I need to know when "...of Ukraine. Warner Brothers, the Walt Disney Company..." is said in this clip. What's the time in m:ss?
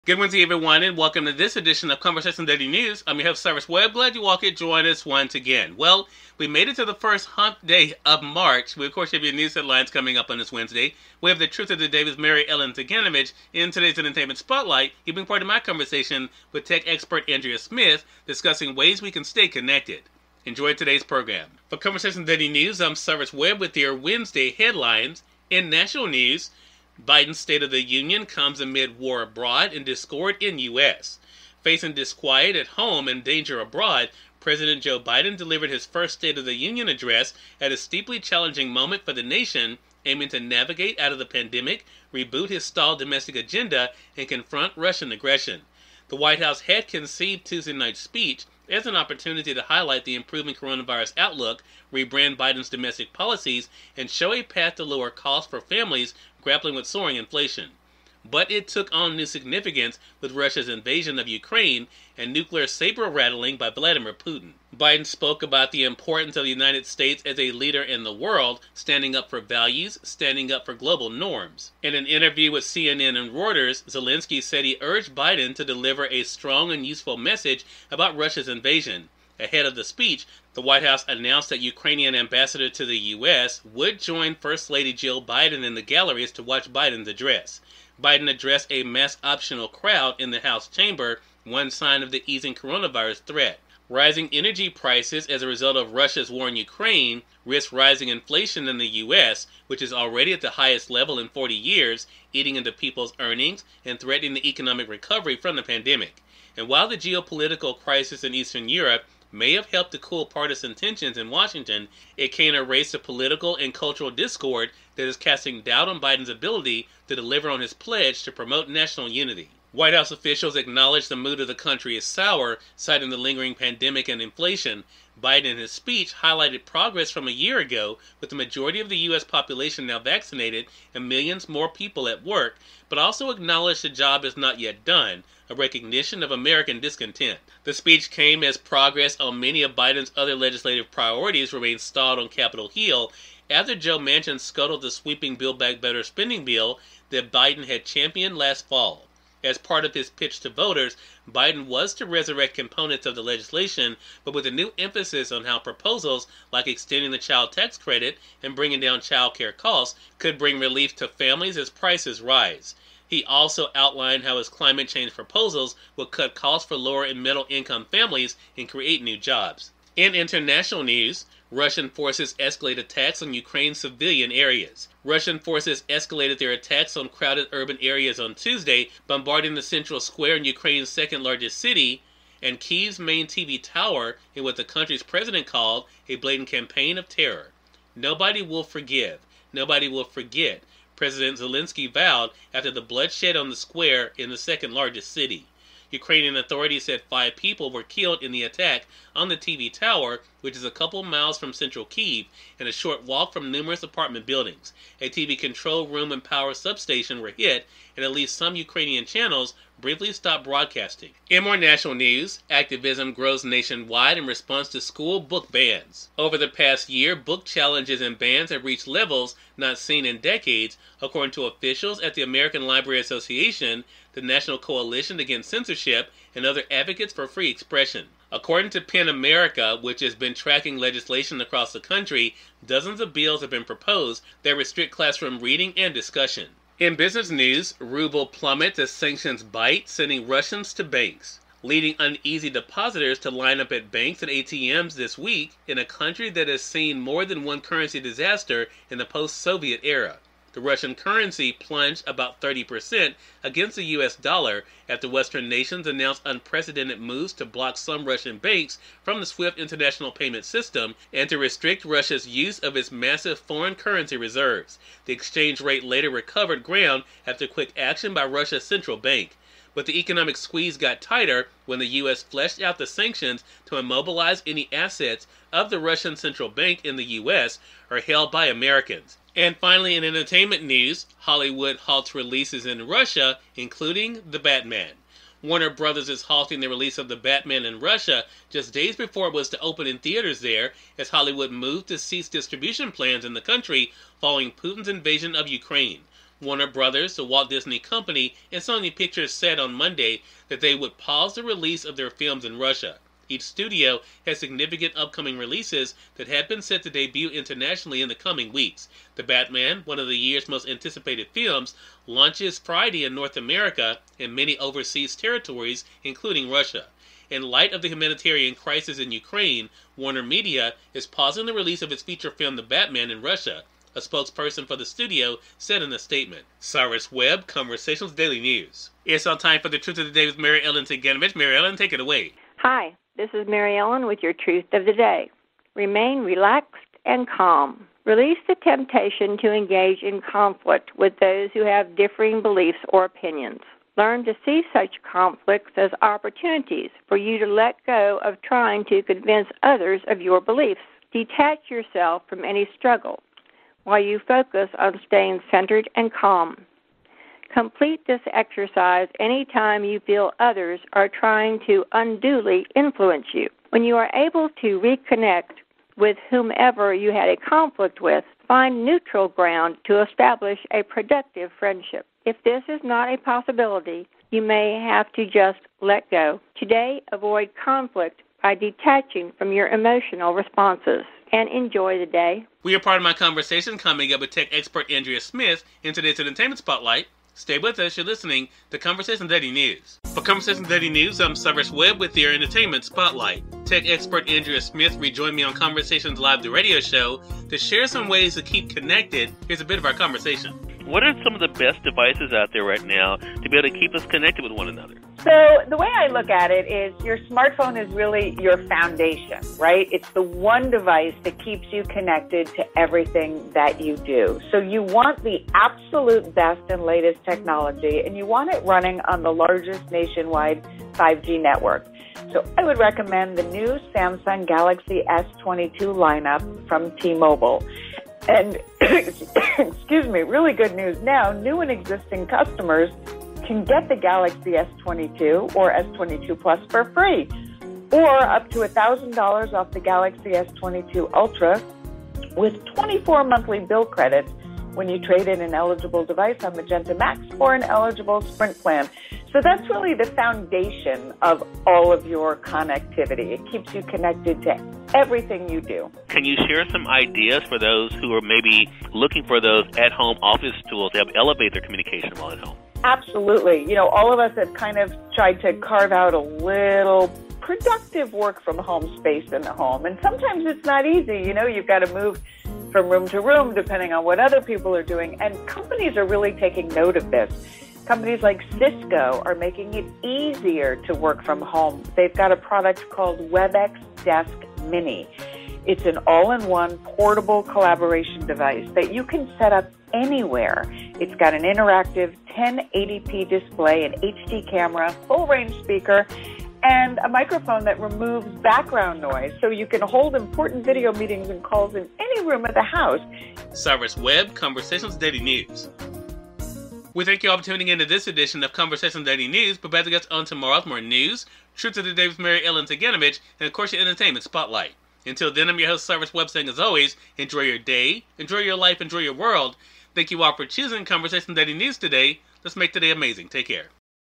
4:55.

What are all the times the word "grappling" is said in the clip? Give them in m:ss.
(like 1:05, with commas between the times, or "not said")
0:56.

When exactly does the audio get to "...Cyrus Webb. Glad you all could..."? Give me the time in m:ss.
0:03.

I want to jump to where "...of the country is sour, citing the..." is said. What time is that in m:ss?
2:01.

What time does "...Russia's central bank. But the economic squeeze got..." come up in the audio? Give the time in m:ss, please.
4:28.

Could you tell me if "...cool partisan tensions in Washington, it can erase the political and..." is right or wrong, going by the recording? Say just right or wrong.
right.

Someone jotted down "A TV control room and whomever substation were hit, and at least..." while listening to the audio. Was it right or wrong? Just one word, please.
wrong.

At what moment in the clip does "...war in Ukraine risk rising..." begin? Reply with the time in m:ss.
1:36.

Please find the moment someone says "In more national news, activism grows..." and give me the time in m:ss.
3:31.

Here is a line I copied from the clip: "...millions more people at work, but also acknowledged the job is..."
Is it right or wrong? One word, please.
right.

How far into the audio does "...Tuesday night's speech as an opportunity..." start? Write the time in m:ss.
0:47.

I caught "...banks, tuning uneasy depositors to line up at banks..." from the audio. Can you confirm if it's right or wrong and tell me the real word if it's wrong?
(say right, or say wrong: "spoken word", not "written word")
wrong: "leading", not "tuning".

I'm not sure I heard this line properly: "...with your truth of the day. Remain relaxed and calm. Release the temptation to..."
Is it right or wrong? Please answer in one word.
right.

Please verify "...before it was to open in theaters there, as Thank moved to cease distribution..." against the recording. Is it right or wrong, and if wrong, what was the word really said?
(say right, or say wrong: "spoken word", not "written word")
wrong: "Hollywood", not "Thank".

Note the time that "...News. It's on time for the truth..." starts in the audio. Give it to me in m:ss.
5:28.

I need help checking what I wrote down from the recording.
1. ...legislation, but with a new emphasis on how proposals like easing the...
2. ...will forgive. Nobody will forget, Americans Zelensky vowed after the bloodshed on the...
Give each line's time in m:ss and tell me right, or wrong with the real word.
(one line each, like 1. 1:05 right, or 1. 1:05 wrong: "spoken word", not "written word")
1. 2:33 wrong: "extending", not "easing"
2. 3:08 wrong: "President", not "Americans".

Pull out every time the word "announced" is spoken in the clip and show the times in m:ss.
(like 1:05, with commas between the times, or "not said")
1:21, 4:15.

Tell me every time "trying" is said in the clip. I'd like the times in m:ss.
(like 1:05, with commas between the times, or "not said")
5:48, 6:01.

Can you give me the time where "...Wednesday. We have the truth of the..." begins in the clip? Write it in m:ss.
0:10.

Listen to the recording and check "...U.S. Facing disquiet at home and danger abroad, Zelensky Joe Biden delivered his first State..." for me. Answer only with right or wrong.
wrong.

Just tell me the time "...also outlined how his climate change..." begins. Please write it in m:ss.
2:43.